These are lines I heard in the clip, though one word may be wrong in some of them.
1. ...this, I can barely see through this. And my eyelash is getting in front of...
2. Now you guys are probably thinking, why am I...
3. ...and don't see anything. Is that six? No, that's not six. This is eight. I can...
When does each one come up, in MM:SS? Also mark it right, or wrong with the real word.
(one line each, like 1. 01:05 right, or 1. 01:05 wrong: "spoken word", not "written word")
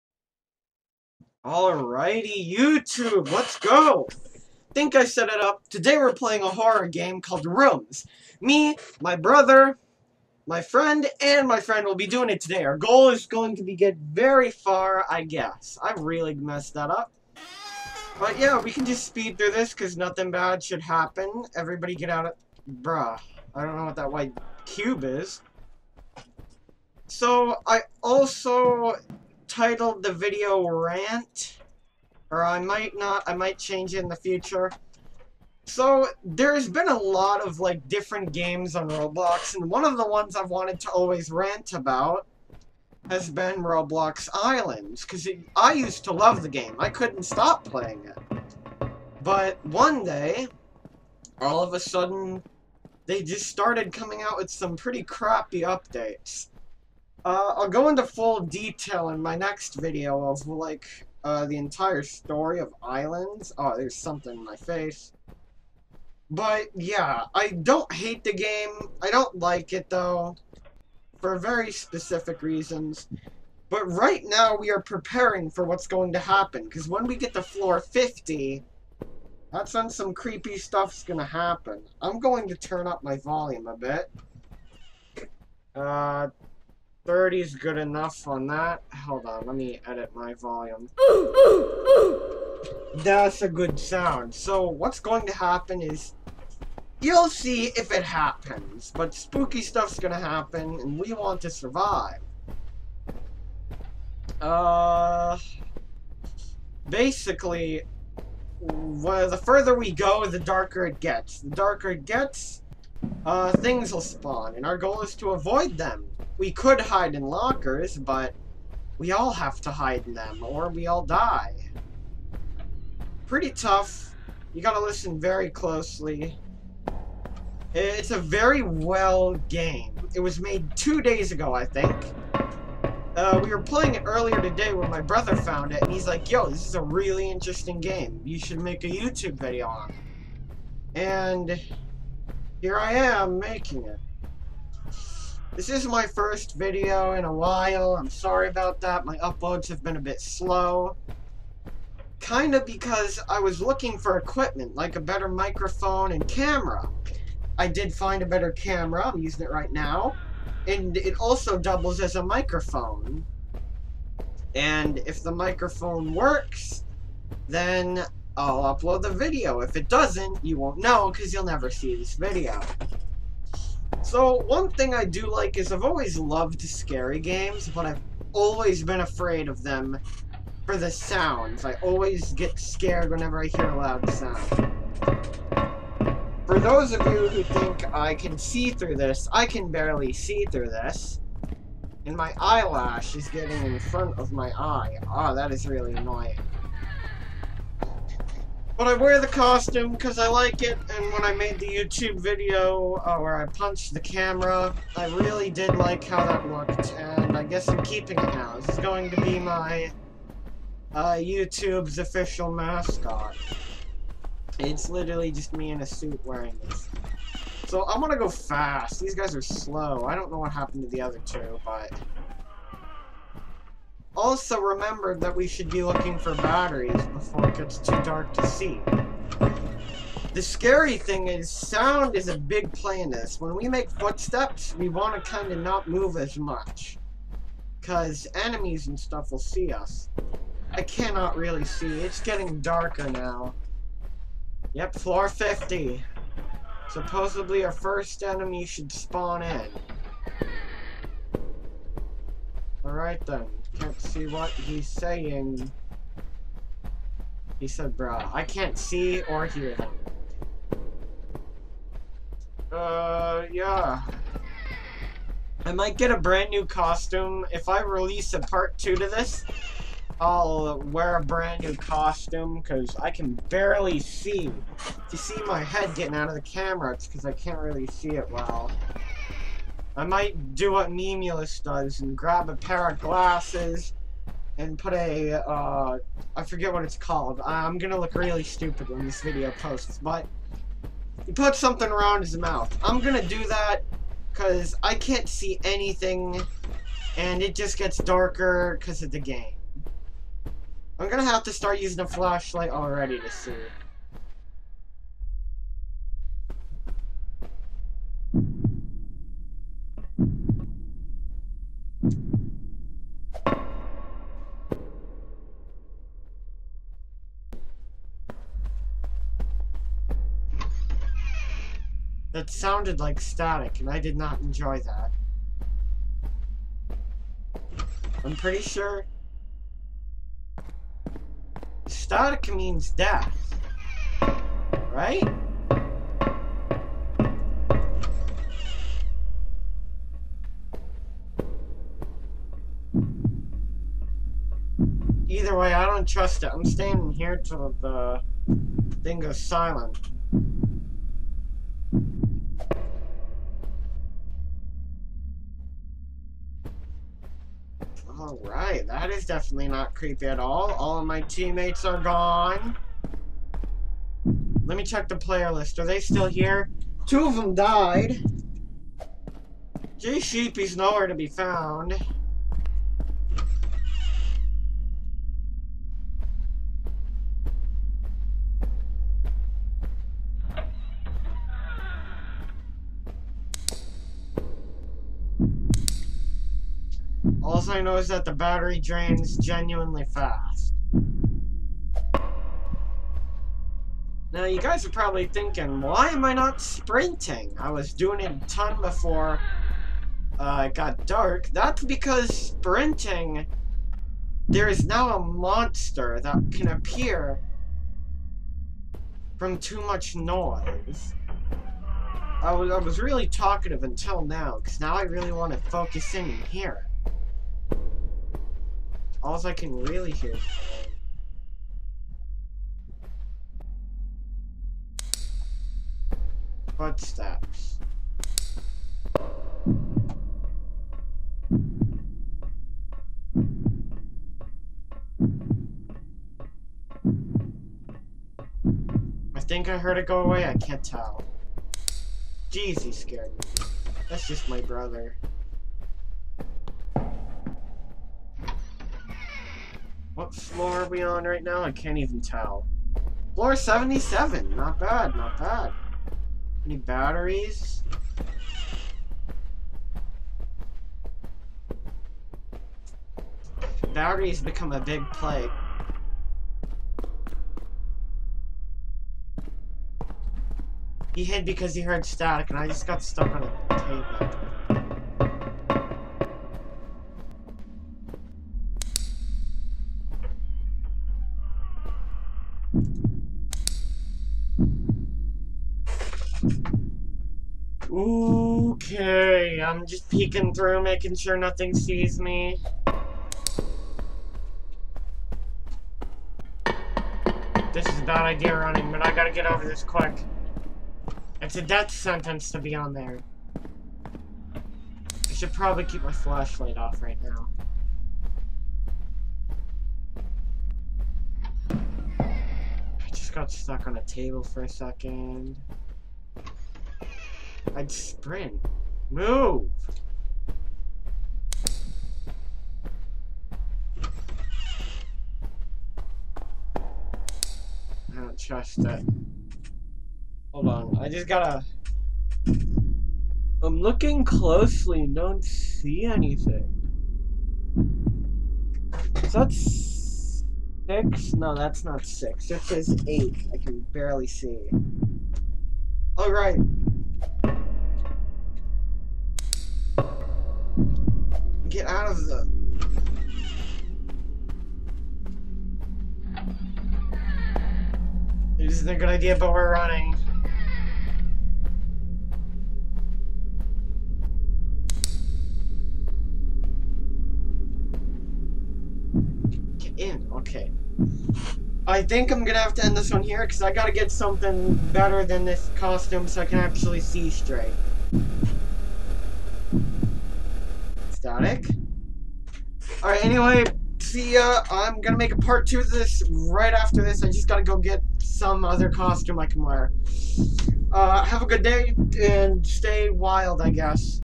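1. 03:08 right
2. 06:34 right
3. 08:55 right.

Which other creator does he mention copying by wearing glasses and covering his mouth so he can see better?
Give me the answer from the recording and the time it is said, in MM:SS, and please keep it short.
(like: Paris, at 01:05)
Nemulus, at 04:40.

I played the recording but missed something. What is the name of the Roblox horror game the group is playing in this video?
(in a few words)
Rooms.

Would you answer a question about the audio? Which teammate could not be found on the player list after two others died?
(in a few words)
J Sheepy.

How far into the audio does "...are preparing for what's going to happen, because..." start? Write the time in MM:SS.
01:14.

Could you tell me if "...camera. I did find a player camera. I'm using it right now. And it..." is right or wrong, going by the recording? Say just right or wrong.
wrong.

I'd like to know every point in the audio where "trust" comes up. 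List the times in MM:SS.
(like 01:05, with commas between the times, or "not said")
05:46, 08:48.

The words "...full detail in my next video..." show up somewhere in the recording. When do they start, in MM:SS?
00:58.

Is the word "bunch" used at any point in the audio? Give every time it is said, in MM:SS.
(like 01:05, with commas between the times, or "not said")
not said.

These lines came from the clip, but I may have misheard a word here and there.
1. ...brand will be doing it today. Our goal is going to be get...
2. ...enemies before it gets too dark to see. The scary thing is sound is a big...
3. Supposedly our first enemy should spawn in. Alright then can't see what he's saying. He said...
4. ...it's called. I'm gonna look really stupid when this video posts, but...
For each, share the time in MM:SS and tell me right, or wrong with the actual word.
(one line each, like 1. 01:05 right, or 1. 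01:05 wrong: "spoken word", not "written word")
1. 00:11 wrong: "friend", not "brand"
2. 03:46 wrong: "batteries", not "enemies"
3. 04:06 right
4. 04:46 right.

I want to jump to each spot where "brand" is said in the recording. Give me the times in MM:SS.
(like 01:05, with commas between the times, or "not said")
04:26, 04:31.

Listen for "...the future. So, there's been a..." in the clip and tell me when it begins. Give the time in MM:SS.
00:34.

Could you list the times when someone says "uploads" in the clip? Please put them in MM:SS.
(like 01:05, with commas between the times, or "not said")
02:29, 02:48.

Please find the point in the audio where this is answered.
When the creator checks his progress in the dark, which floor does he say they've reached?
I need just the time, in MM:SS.
07:33.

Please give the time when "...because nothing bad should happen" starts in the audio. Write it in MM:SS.
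00:19.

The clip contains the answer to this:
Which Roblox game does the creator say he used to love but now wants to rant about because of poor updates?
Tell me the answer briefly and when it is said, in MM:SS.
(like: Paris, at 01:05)
Roblox Islands, at 00:43.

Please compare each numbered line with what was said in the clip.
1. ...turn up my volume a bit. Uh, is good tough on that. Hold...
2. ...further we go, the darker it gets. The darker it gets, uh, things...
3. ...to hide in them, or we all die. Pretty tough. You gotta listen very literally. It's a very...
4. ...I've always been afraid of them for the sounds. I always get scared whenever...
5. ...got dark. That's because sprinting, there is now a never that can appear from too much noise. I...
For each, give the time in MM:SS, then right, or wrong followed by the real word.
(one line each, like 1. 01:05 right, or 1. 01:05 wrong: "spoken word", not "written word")
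1. 01:22 wrong: "enough", not "tough"
2. 01:49 right
3. 01:59 wrong: "closely", not "literally"
4. 02:57 right
5. 06:40 wrong: "monster", not "never".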